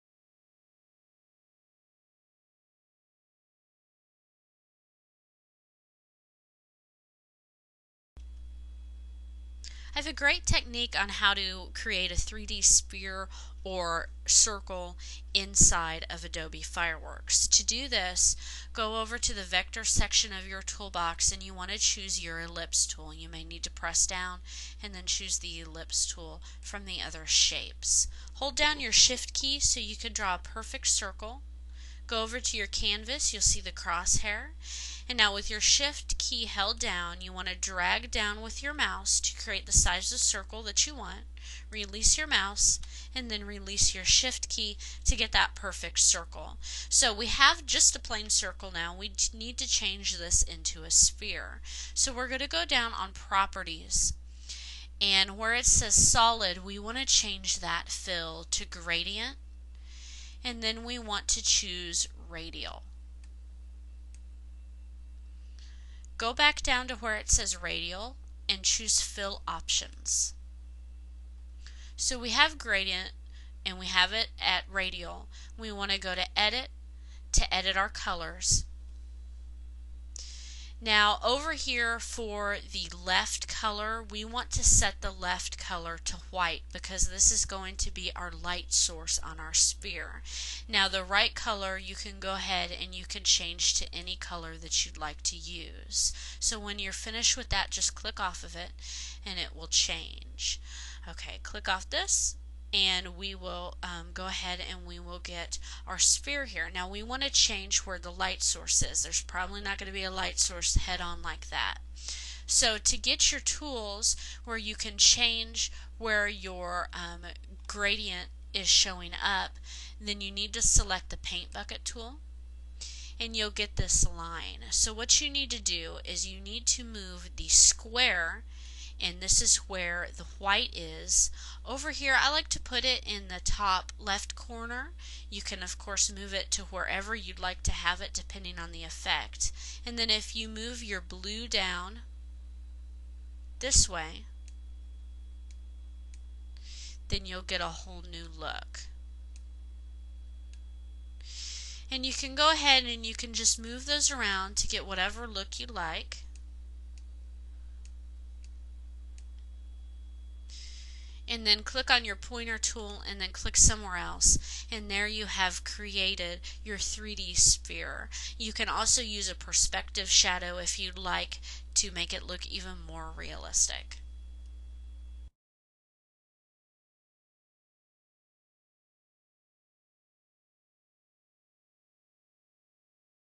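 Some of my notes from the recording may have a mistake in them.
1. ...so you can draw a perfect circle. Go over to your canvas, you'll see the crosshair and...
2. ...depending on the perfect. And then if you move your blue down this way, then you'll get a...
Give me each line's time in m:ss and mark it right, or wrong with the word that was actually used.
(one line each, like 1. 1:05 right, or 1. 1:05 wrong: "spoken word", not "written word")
1. 0:29 right
2. 2:18 wrong: "effect", not "perfect".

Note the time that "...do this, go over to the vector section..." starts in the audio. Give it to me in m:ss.
0:17.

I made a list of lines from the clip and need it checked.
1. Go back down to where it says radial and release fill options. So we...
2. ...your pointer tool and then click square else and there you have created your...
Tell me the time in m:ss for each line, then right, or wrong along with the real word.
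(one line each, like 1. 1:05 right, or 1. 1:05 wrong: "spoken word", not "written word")
1. 1:06 wrong: "choose", not "release"
2. 2:42 wrong: "somewhere", not "square".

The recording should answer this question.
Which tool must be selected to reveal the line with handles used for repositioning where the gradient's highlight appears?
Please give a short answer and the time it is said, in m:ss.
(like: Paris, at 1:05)
Paint bucket tool, at 2:01.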